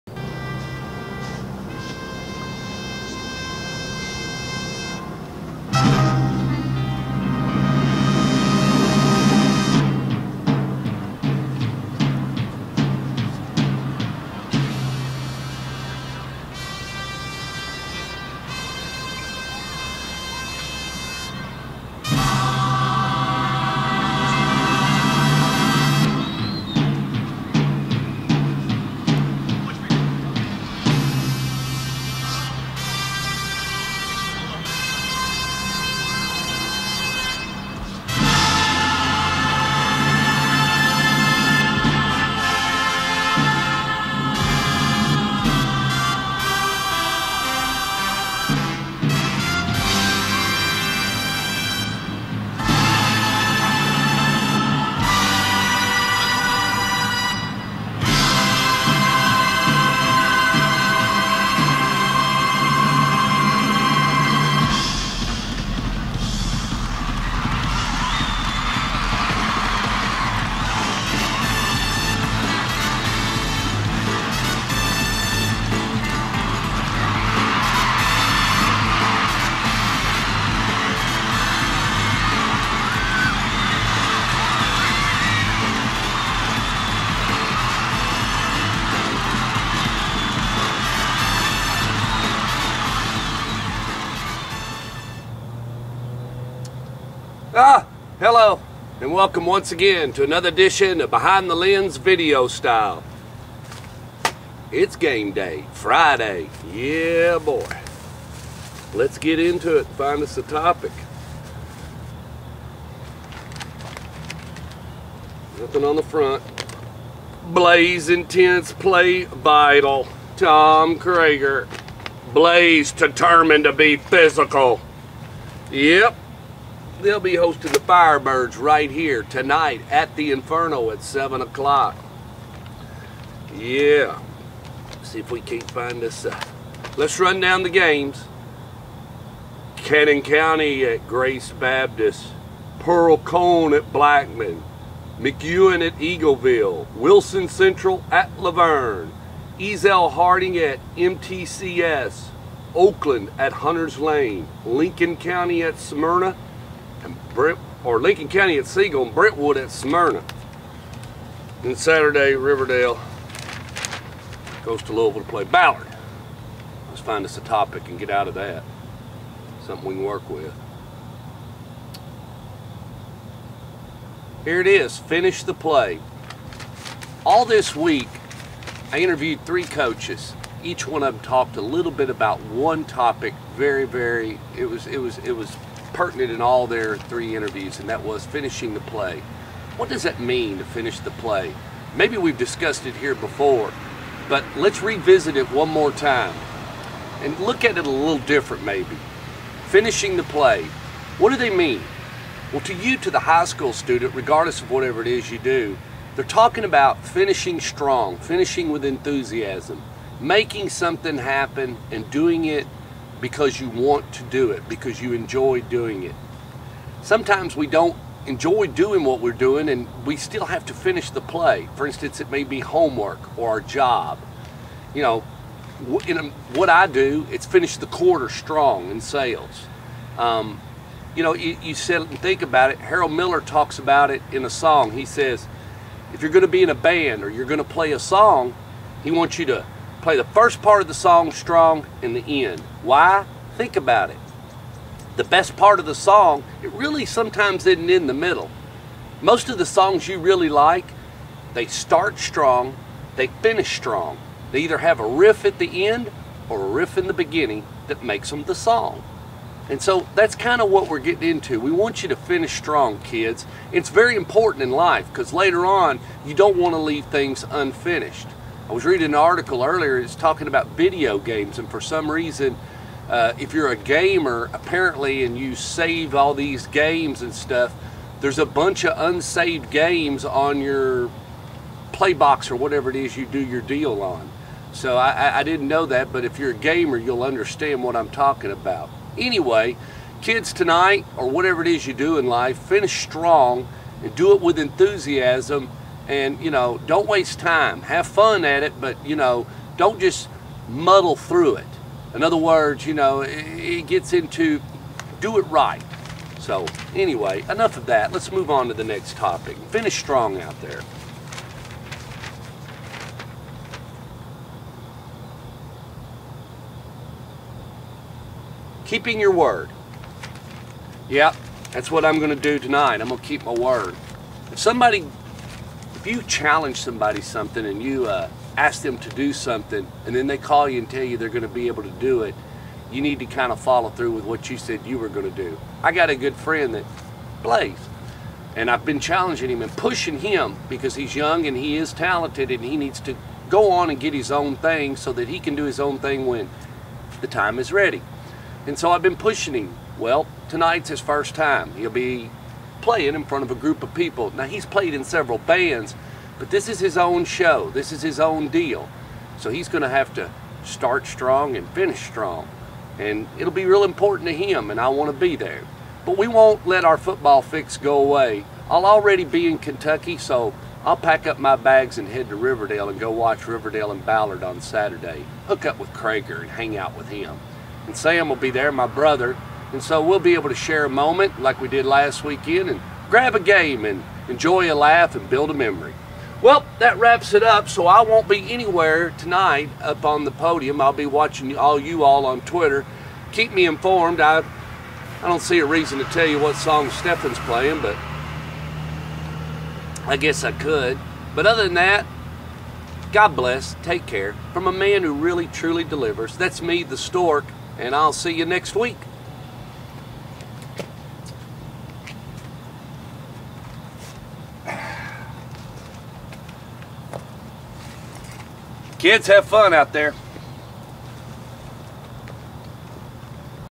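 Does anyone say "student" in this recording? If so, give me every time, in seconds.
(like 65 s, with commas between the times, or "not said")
203 s.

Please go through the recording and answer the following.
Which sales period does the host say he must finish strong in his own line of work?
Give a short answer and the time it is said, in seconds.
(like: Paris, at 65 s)
the quarter, at 227 s.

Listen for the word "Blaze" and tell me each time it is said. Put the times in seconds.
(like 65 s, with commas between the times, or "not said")
117 s, 122 s.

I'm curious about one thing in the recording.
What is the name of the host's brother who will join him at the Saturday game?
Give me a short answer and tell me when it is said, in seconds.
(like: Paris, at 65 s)
Sam, at 377 s.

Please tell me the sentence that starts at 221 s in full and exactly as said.
For instance, it may be homework or our job.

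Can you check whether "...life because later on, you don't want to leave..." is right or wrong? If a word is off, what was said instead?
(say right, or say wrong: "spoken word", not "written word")
right.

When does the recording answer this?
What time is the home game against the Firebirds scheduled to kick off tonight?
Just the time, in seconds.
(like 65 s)
131 s.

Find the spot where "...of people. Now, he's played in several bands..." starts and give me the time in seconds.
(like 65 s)
353 s.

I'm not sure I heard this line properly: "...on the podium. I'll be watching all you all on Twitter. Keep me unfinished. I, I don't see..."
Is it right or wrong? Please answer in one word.
wrong.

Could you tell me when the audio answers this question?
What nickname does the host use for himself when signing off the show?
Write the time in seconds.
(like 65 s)
406 s.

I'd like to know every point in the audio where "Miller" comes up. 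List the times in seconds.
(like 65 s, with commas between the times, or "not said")
233 s.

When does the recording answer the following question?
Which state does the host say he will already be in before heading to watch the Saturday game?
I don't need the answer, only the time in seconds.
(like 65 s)
369 s.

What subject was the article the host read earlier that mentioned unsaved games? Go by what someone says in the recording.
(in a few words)
video games.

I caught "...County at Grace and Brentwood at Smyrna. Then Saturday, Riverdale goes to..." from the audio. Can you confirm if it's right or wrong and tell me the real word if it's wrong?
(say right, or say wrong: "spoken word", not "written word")
wrong: "Siegel", not "Grace".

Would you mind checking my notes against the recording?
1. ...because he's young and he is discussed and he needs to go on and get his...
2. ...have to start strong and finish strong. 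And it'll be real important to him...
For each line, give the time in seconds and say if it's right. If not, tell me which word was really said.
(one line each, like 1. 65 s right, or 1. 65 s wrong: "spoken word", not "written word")
1. 340 s wrong: "talented", not "discussed"
2. 359 s right.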